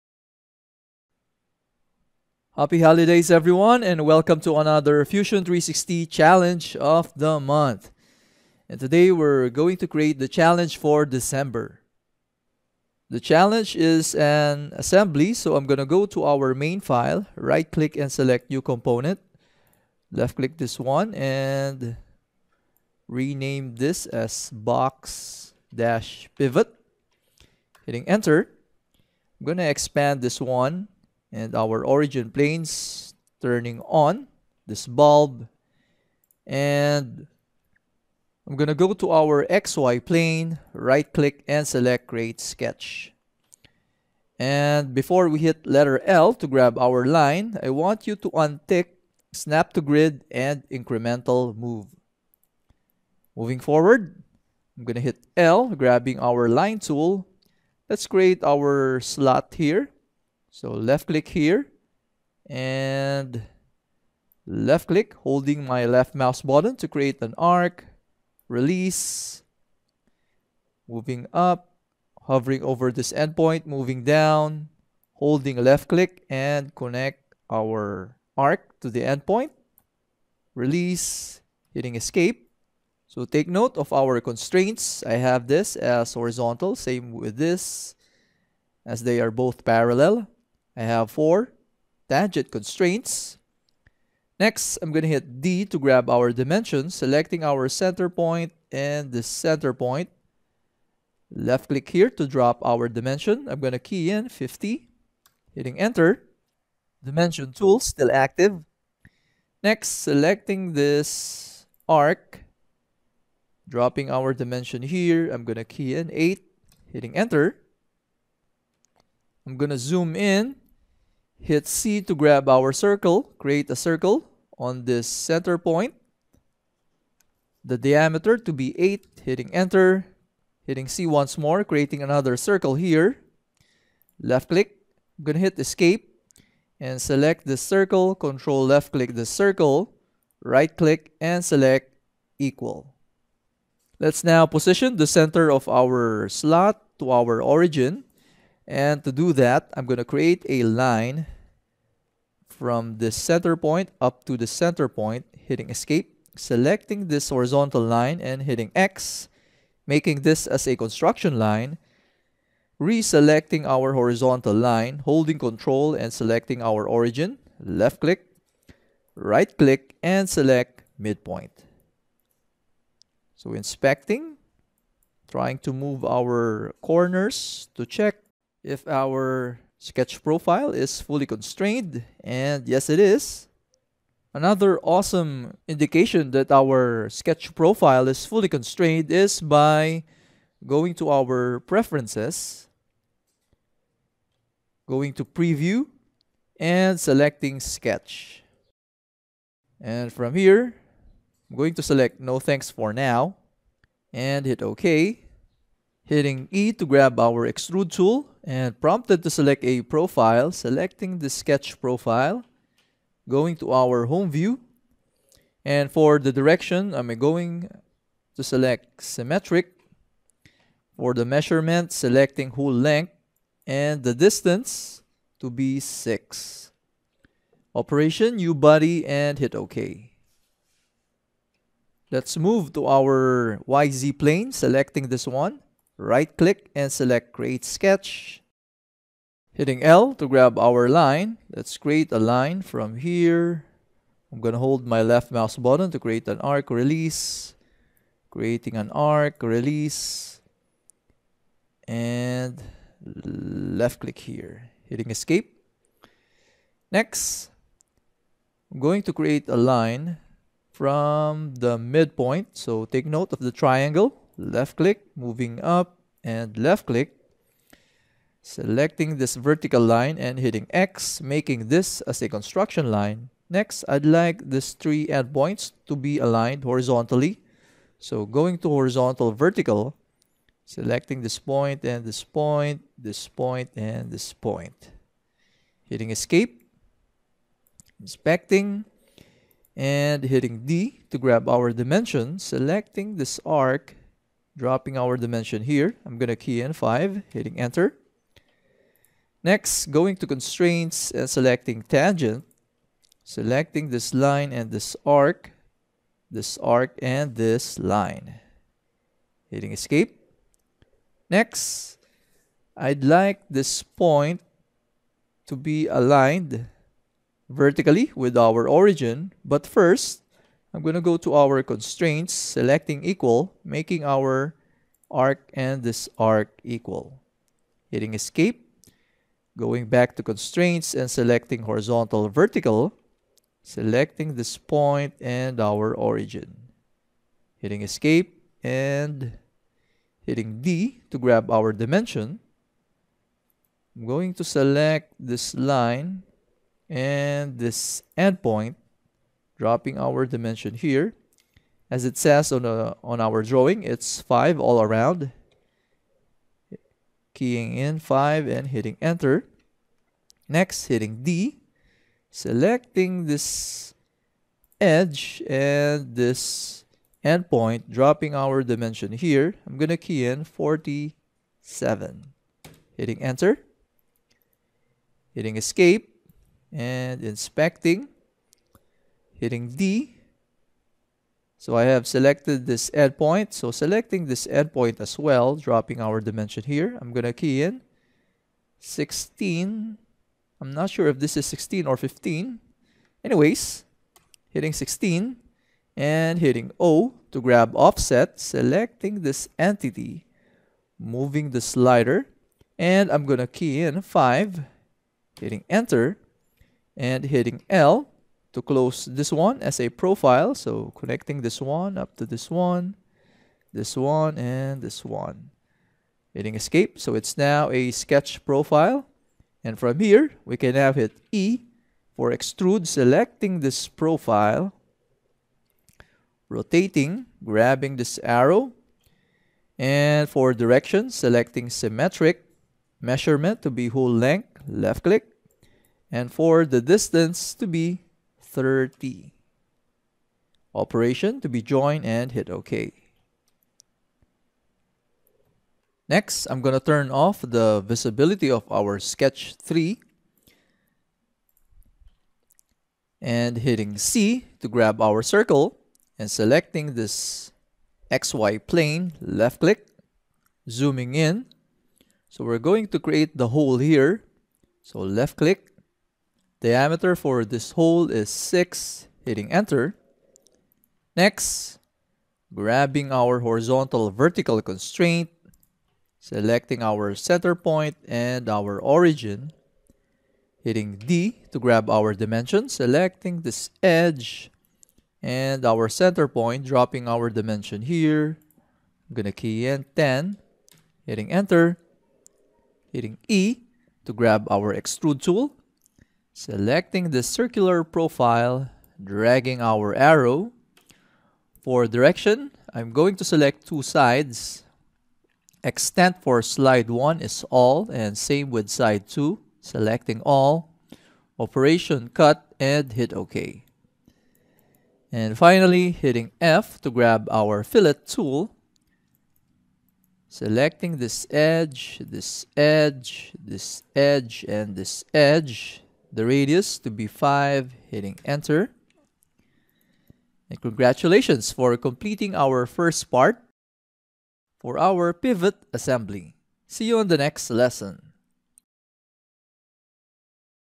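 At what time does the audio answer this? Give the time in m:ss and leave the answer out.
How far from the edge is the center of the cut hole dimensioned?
8:09.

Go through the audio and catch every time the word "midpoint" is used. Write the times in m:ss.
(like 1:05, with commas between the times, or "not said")
2:50, 4:21.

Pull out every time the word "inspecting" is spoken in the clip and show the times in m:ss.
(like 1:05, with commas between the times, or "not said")
2:53, 4:47, 6:17.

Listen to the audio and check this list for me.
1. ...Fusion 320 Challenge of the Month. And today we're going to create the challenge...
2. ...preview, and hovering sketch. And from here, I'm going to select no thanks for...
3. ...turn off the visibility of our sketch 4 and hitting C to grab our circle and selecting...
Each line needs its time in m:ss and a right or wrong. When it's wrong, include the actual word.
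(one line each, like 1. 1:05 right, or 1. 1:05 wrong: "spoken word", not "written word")
1. 0:05 wrong: "360", not "320"
2. 3:15 wrong: "selecting", not "hovering"
3. 7:26 wrong: "3", not "4".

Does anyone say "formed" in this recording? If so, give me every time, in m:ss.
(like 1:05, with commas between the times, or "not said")
not said.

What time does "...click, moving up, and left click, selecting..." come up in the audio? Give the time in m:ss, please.
4:24.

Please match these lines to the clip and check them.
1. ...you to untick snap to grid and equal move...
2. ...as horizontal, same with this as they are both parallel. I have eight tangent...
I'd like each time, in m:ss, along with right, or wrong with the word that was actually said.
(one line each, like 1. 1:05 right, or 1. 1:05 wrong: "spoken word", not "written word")
1. 0:48 wrong: "incremental", not "equal"
2. 1:25 wrong: "four", not "eight".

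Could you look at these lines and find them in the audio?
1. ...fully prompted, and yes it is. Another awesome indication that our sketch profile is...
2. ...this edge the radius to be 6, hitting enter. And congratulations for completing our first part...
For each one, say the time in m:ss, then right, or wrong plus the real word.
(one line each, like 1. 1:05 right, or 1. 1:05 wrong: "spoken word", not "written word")
1. 3:01 wrong: "constrained", not "prompted"
2. 8:44 wrong: "5", not "6".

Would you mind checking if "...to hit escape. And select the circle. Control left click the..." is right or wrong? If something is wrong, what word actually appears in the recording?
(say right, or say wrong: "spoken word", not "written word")
right.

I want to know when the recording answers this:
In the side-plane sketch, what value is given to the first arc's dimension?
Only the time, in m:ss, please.
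4:56.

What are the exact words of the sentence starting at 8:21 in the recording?
For direction, I'm going to select two sides.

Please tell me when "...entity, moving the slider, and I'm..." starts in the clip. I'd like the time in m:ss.
6:39.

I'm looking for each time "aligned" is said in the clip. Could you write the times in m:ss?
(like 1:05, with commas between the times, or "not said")
4:36, 5:15.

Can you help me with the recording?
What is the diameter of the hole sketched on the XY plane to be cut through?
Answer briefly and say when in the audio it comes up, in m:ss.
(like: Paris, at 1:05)
6, at 7:46.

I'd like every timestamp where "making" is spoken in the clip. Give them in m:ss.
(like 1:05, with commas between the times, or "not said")
2:39, 4:31, 5:23.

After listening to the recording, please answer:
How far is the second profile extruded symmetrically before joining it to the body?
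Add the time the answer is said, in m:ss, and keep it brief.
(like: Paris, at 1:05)
30, at 7:18.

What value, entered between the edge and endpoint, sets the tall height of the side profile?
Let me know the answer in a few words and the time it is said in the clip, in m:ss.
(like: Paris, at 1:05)
47, at 6:10.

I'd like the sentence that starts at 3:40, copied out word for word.
For the measurement, selecting whole length and the distance to be 6.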